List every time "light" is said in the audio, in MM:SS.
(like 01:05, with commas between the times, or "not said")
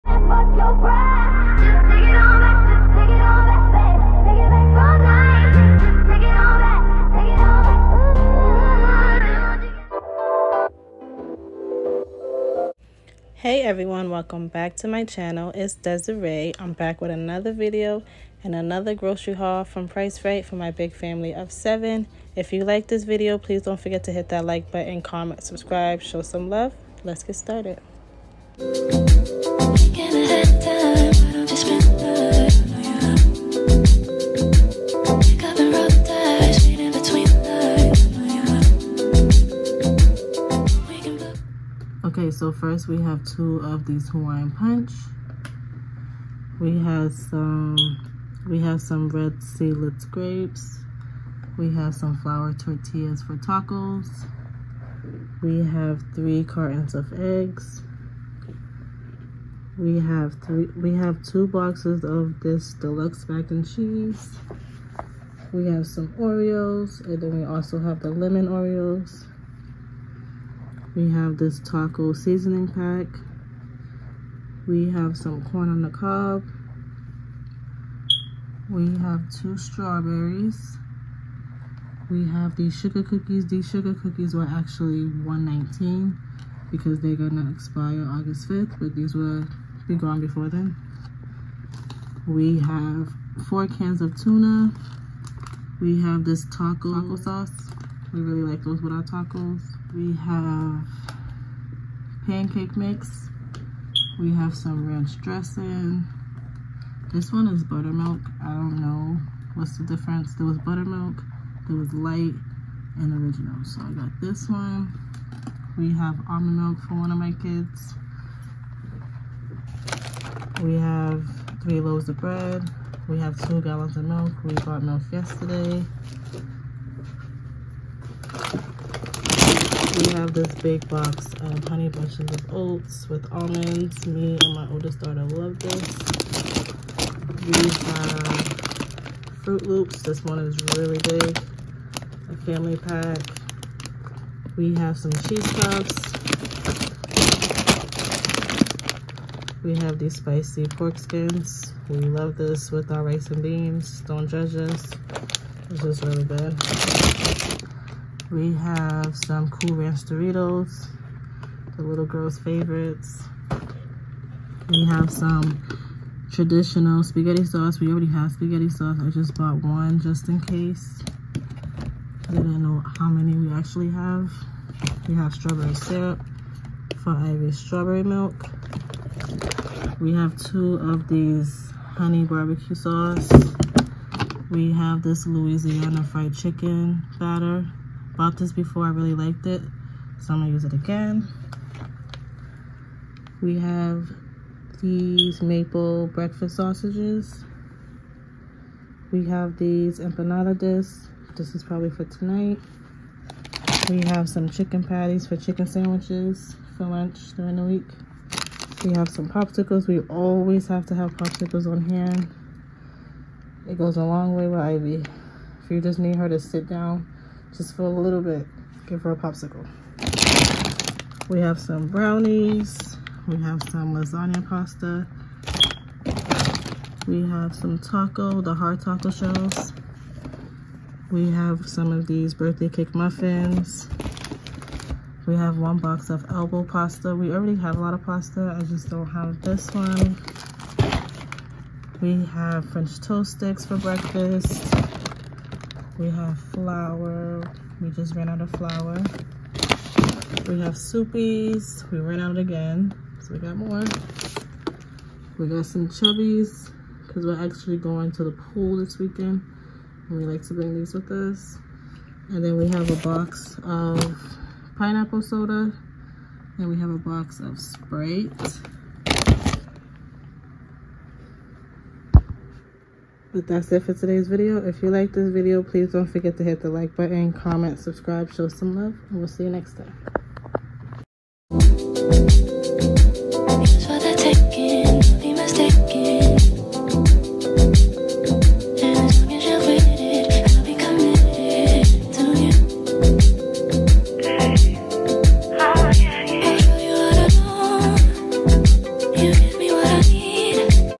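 01:51.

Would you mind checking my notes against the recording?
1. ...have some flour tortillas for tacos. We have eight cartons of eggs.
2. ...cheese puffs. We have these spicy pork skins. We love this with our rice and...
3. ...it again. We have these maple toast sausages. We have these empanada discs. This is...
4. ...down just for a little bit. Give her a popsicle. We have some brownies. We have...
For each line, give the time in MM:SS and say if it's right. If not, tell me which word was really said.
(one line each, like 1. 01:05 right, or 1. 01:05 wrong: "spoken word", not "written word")
1. 00:51 wrong: "three", not "eight"
2. 02:25 right
3. 03:10 wrong: "breakfast", not "toast"
4. 03:36 right.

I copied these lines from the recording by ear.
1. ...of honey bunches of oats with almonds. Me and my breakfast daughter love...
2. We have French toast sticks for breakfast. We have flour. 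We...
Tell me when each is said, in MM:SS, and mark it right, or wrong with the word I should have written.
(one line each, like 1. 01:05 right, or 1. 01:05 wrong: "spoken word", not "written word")
1. 02:11 wrong: "oldest", not "breakfast"
2. 04:02 right.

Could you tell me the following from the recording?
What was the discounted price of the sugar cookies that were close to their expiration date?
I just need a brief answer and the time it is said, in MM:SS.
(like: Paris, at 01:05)
1.19, at 01:25.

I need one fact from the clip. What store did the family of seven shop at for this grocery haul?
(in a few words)
Price Rite.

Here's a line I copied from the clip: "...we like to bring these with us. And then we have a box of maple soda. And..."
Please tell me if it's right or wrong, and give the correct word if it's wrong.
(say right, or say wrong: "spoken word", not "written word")
wrong: "pineapple", not "maple".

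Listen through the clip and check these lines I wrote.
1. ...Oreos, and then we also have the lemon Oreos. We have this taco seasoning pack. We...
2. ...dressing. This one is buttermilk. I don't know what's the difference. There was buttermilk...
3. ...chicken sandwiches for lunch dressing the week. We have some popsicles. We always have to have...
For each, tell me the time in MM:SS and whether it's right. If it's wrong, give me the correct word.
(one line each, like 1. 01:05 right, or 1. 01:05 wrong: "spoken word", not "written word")
1. 01:06 right
2. 01:45 right
3. 03:25 wrong: "during", not "dressing".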